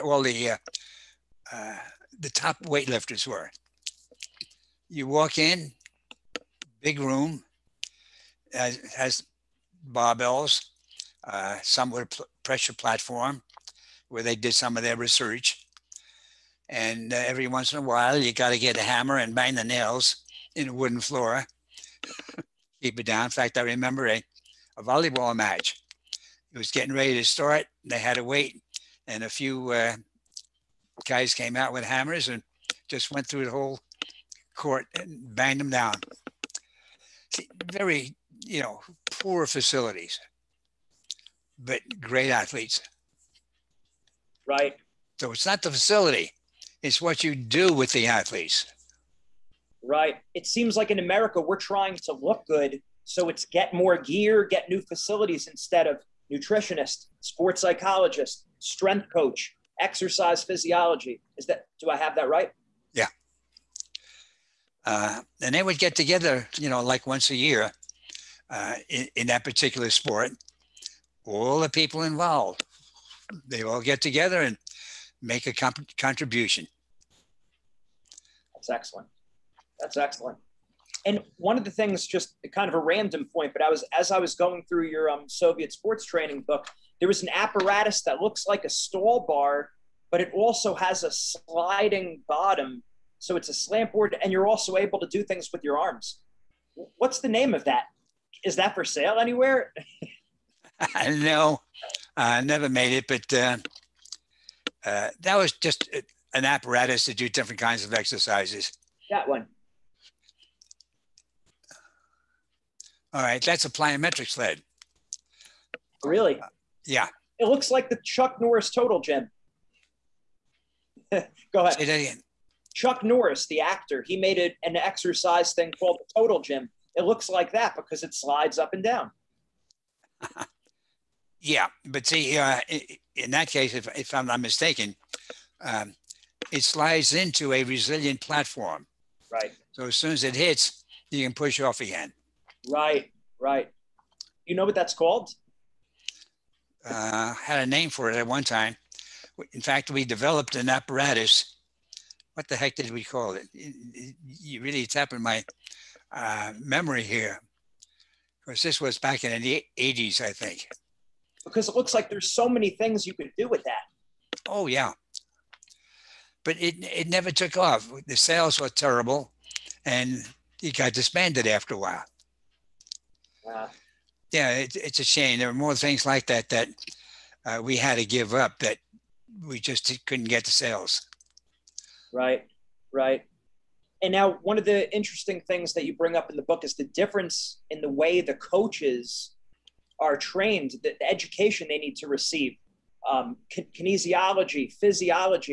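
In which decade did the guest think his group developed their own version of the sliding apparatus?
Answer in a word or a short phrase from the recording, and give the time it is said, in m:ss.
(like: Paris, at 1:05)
the '80s, at 2:39.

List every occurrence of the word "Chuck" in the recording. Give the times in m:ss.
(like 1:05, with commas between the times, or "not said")
1:58, 2:02.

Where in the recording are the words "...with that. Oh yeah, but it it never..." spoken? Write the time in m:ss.
2:43.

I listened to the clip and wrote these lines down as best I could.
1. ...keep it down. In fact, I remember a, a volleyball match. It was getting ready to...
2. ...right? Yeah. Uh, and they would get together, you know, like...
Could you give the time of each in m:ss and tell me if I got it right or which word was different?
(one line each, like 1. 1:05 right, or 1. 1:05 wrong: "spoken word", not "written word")
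1. 0:22 right
2. 1:02 right.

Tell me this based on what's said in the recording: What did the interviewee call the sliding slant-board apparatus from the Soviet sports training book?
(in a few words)
plyometric sled.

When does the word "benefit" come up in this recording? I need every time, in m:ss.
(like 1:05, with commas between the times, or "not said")
not said.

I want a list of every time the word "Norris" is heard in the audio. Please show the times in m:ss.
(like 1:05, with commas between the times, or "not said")
1:58, 2:03.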